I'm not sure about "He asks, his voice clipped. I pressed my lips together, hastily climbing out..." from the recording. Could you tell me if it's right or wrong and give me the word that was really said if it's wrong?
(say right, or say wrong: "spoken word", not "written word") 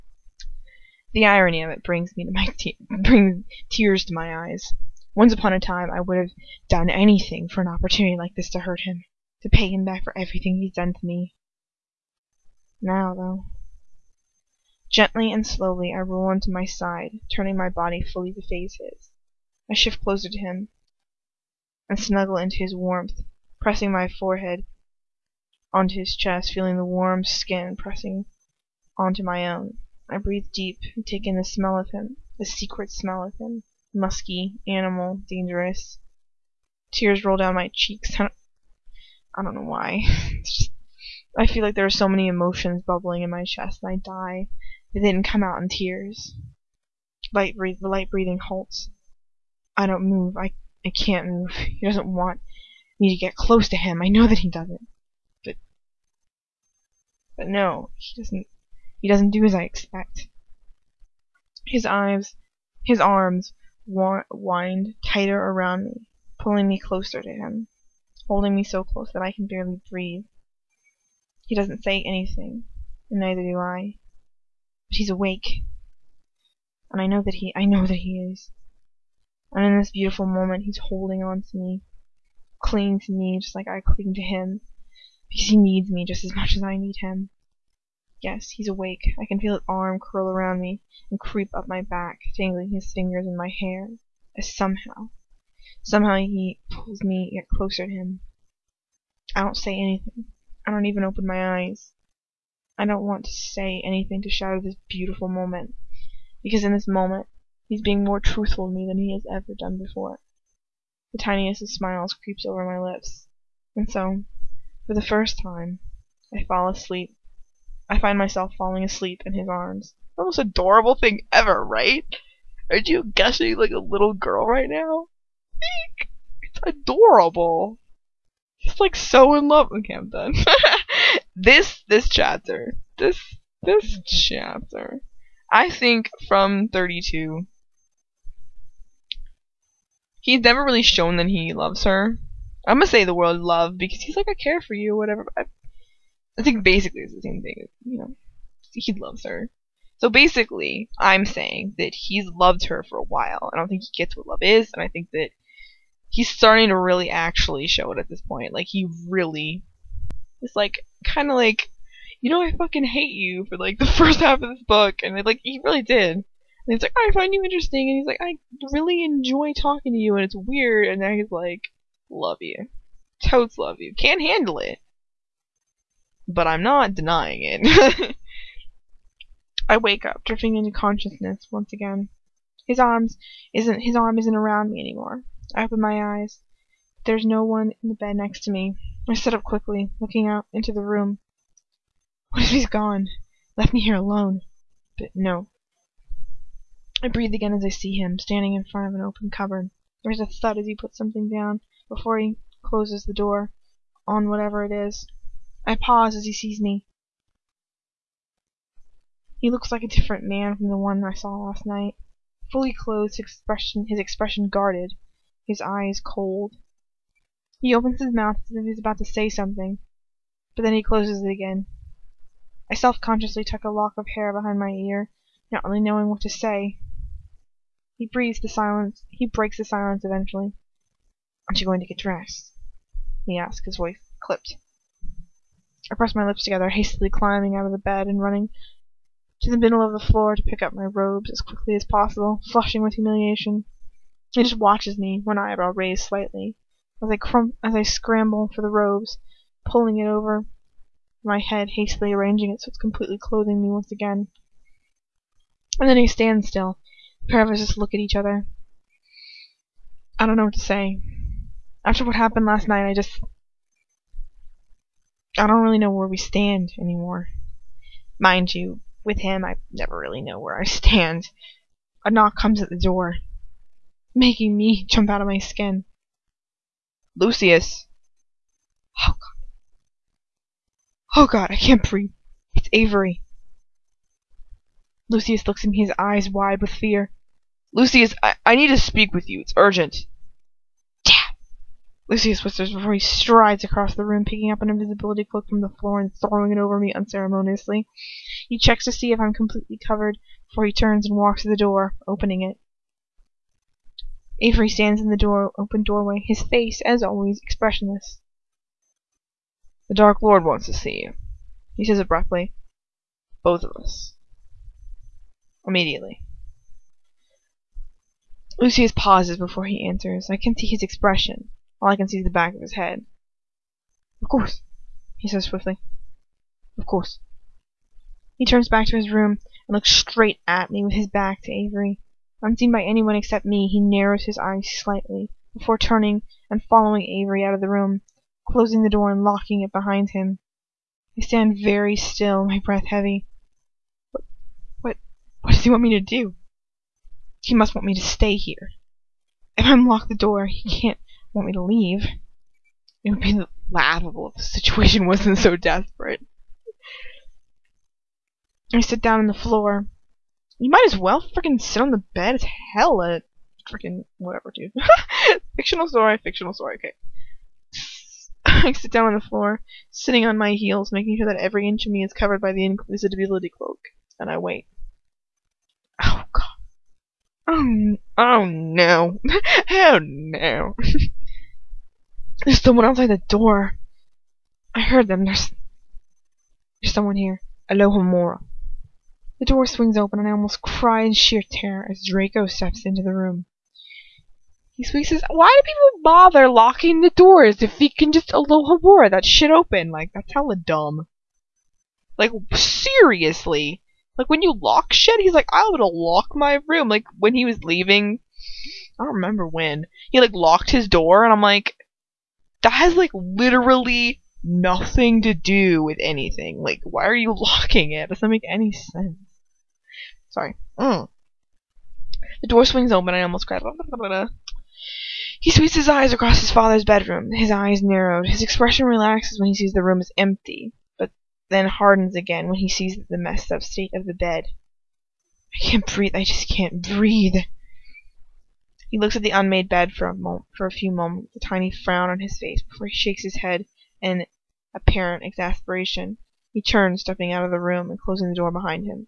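right.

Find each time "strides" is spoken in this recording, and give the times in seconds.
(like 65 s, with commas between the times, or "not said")
292 s.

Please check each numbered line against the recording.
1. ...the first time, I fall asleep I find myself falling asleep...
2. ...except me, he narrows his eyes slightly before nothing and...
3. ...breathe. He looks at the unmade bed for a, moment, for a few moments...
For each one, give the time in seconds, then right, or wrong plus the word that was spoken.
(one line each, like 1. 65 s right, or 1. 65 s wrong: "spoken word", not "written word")
1. 114 s right
2. 333 s wrong: "turning", not "nothing"
3. 436 s right.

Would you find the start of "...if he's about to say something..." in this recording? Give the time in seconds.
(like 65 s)
218 s.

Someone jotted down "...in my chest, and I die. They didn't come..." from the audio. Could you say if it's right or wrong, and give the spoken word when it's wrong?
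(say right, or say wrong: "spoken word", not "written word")
right.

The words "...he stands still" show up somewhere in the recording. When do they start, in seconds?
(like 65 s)
255 s.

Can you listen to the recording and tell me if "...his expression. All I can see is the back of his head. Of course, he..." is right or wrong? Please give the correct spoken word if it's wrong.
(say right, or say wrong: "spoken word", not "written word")
right.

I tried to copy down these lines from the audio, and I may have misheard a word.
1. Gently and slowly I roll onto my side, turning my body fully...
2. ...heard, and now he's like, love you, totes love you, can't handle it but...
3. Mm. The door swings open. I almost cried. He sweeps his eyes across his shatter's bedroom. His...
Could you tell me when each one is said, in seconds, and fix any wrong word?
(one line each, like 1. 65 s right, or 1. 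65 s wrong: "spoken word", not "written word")
1. 14 s right
2. 170 s wrong: "weird", not "heard"
3. 420 s wrong: "father", not "shatter".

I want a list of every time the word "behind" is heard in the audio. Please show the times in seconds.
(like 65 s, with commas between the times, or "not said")
224 s, 339 s, 448 s.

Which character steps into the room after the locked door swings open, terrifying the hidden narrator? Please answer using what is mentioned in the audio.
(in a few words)
Draco.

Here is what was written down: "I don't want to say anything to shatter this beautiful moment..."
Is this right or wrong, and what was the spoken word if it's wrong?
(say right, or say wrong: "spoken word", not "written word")
right.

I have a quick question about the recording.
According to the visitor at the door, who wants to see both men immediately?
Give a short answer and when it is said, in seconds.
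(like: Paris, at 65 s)
The Dark Lord, at 309 s.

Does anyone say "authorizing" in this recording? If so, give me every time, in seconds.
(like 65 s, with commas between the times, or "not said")
not said.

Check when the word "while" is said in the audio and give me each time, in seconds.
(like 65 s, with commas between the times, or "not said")
153 s.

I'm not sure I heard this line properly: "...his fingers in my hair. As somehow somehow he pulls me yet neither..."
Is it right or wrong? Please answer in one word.
wrong.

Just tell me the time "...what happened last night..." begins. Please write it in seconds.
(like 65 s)
262 s.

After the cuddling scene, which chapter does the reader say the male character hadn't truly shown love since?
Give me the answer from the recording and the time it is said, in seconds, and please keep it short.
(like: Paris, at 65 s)
32, at 136 s.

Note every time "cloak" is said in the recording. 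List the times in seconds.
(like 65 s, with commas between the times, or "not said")
295 s, 373 s.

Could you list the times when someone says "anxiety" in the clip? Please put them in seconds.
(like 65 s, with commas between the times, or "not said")
not said.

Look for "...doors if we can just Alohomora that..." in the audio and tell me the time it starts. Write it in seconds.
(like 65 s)
397 s.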